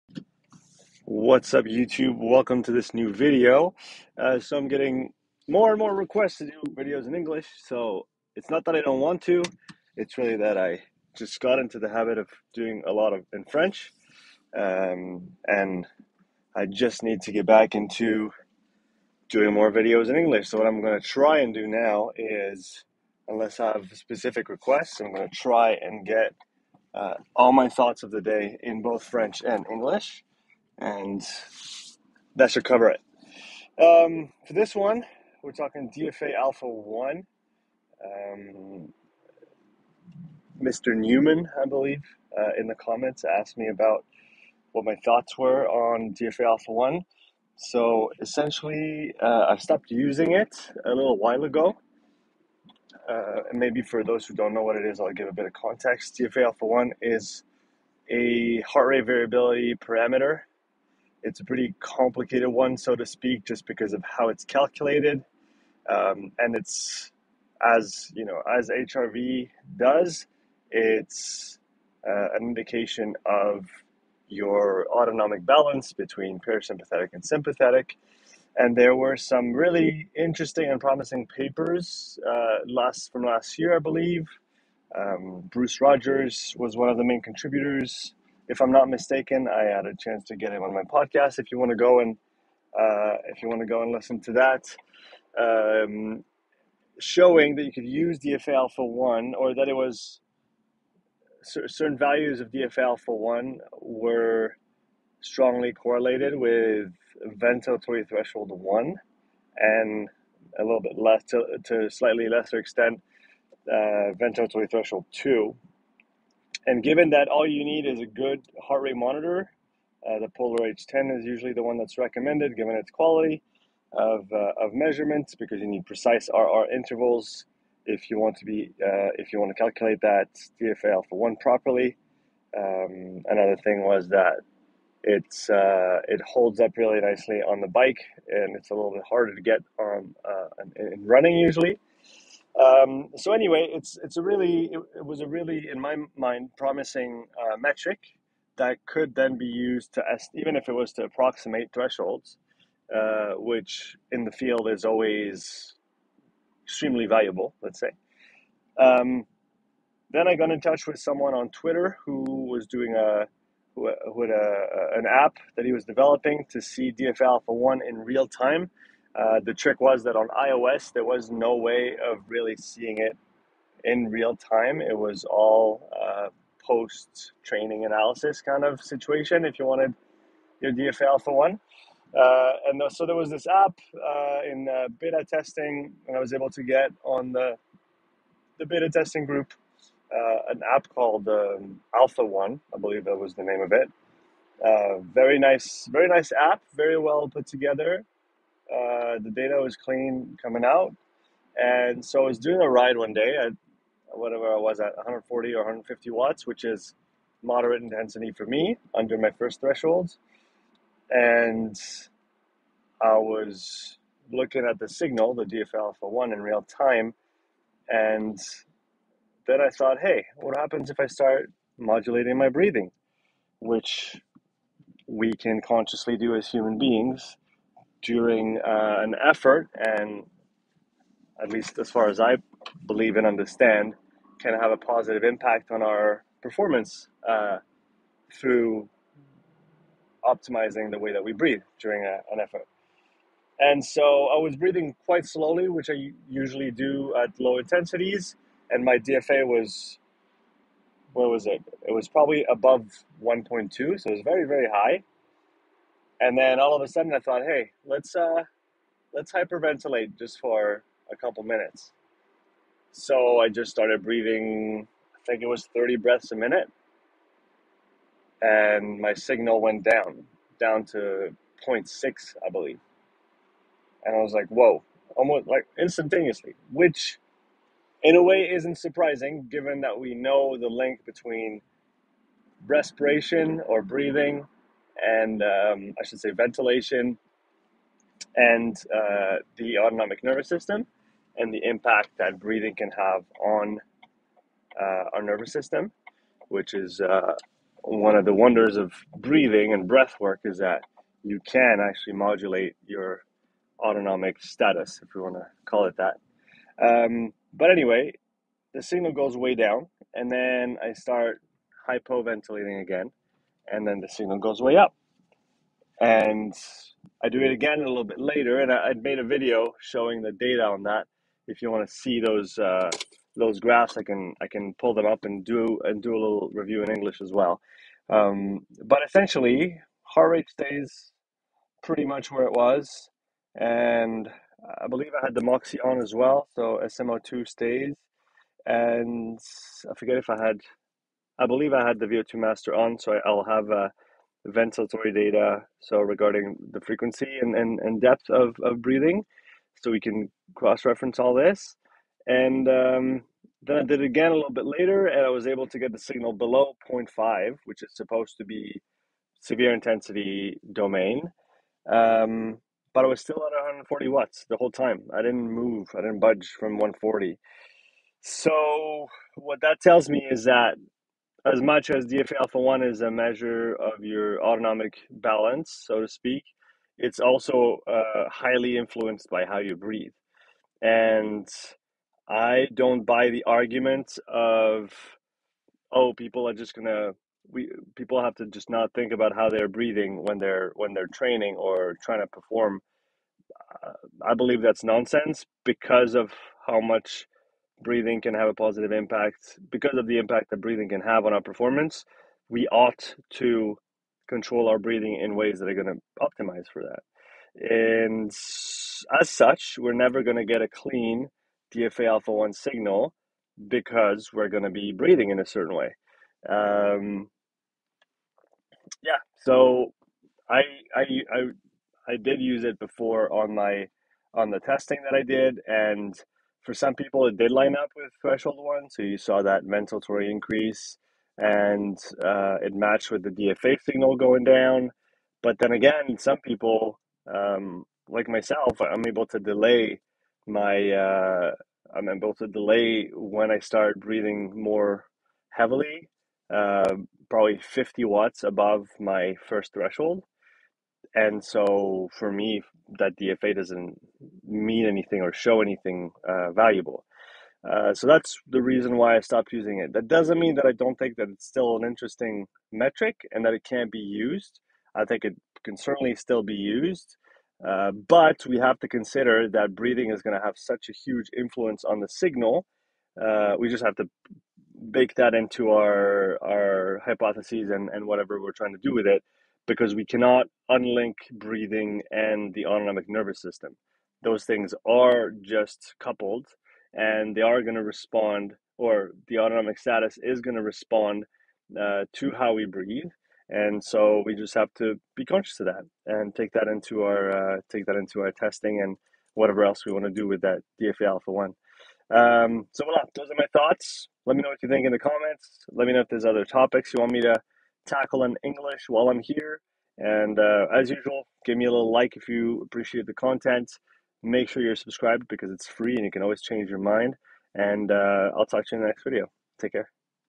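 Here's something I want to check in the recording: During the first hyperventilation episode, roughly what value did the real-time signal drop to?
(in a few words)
0.6.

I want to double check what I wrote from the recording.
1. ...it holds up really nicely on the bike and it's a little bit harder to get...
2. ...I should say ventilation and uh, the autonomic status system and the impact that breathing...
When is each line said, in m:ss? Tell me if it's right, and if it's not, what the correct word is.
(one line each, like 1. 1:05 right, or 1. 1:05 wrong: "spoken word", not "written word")
1. 2:16 right
2. 4:45 wrong: "nervous", not "status".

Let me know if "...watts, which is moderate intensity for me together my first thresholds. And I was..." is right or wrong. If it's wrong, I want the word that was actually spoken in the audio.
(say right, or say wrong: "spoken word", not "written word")
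wrong: "under", not "together".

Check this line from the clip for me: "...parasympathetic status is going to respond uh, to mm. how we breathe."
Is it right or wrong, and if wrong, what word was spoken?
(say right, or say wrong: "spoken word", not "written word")
wrong: "autonomic", not "parasympathetic".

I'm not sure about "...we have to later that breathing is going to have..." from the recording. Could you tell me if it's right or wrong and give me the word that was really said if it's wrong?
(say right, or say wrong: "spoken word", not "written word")
wrong: "consider", not "later".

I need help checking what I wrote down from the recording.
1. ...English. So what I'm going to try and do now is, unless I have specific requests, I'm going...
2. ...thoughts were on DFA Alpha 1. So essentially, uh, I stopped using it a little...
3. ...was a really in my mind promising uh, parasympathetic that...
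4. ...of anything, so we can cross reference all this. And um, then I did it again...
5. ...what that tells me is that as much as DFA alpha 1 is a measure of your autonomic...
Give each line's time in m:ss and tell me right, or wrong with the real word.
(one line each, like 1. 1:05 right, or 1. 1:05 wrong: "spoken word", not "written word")
1. 0:20 right
2. 0:45 right
3. 2:25 wrong: "metric", not "parasympathetic"
4. 5:48 wrong: "breathing", not "anything"
5. 6:09 right.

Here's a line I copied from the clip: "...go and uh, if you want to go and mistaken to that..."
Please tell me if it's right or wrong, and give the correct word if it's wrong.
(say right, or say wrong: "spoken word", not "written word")
wrong: "listen", not "mistaken".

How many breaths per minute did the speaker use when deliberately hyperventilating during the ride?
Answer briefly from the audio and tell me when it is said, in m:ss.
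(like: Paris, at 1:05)
30, at 4:25.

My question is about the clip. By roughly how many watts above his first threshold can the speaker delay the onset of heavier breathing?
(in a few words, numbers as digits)
50 watts.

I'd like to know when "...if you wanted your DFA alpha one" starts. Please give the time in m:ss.
2:59.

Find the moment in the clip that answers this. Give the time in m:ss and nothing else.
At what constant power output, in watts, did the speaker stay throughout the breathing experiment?
6:03.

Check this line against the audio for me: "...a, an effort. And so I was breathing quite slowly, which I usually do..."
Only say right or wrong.
right.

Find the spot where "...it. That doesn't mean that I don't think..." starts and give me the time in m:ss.
7:39.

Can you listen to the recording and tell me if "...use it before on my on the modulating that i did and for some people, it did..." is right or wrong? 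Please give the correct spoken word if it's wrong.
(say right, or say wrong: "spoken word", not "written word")
wrong: "testing", not "modulating".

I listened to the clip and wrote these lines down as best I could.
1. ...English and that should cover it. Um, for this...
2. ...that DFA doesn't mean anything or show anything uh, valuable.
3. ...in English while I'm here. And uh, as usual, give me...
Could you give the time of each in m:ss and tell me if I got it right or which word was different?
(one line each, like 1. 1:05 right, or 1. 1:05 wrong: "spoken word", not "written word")
1. 0:29 right
2. 7:32 right
3. 8:28 right.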